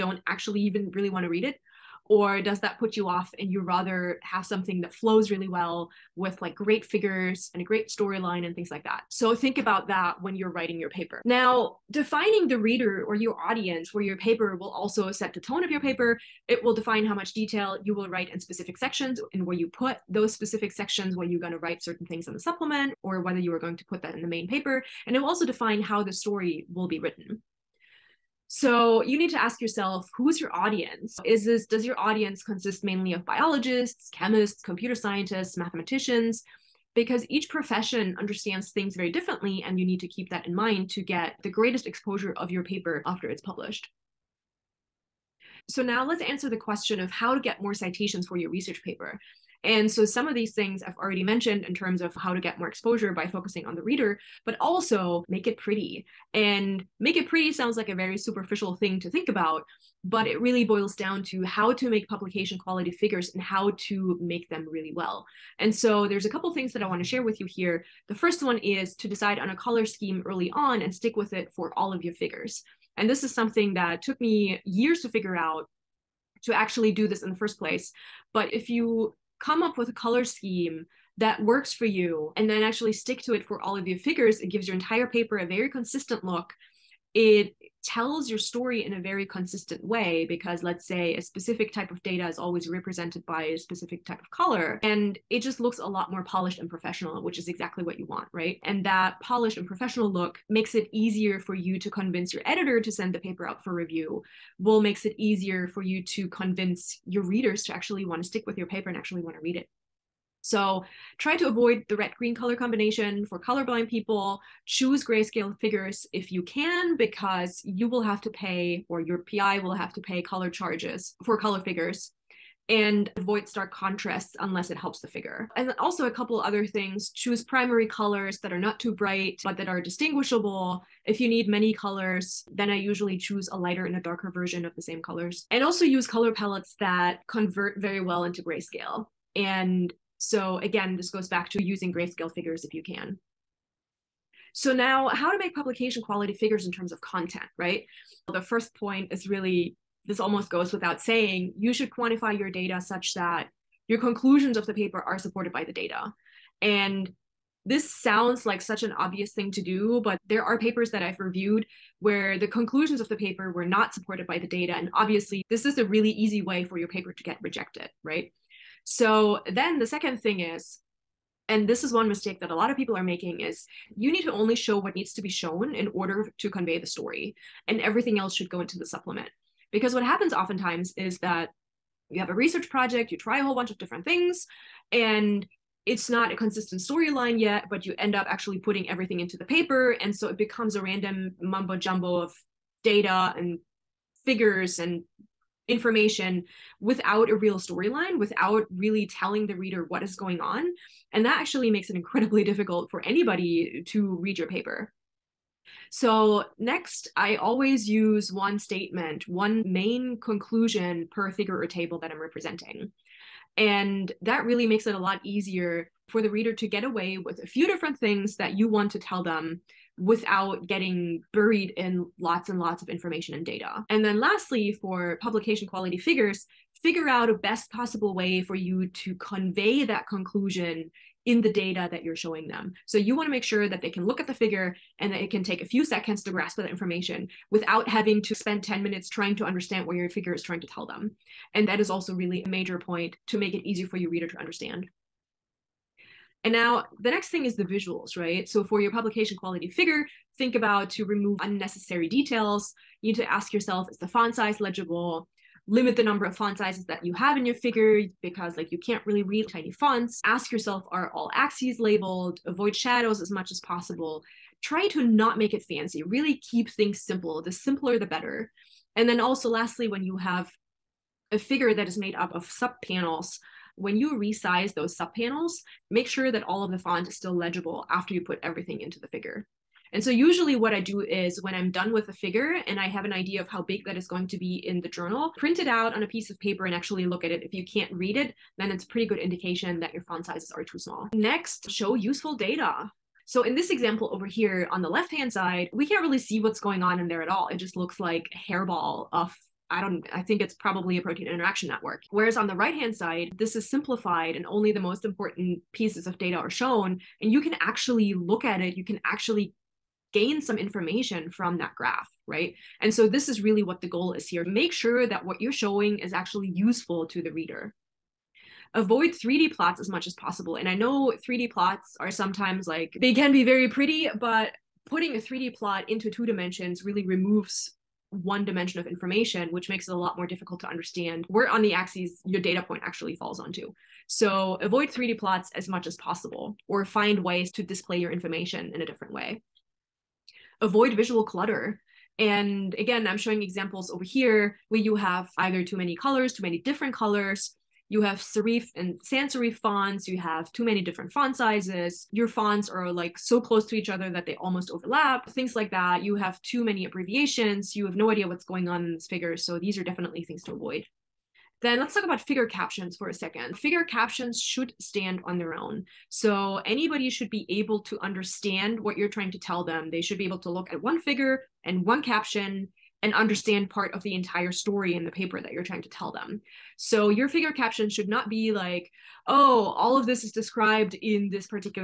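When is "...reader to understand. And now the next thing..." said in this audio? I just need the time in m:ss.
4:04.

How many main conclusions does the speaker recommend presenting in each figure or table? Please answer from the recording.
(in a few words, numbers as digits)
1.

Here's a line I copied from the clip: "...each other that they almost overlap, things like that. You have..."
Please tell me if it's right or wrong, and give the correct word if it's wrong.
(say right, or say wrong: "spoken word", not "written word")
right.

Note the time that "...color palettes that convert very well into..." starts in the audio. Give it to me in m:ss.
2:16.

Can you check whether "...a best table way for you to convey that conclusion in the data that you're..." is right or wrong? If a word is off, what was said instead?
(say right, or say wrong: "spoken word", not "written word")
wrong: "possible", not "table".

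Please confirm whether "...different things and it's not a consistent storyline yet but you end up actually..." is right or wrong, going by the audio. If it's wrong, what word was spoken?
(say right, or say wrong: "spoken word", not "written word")
right.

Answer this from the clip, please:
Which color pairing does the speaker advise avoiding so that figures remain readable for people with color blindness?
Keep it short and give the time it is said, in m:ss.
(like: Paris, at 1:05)
red-green, at 1:51.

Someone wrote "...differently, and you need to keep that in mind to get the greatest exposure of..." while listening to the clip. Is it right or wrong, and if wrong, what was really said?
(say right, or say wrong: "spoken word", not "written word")
right.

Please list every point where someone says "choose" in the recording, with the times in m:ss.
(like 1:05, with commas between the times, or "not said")
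1:54, 2:07, 2:13.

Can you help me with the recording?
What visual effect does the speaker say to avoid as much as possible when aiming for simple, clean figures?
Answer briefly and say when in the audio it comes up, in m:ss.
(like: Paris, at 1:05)
shadows, at 4:22.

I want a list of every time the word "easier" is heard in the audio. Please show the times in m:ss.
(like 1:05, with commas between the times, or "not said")
1:40, 1:45, 3:35.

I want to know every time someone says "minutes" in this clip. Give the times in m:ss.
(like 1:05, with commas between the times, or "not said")
3:58.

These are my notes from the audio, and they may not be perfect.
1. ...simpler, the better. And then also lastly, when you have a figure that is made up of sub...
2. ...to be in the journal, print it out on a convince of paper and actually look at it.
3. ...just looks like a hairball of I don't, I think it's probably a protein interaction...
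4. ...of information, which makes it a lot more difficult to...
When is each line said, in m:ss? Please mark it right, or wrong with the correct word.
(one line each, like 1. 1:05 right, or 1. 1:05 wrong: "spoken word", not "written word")
1. 4:27 right
2. 4:44 wrong: "piece", not "convince"
3. 4:57 right
4. 5:28 right.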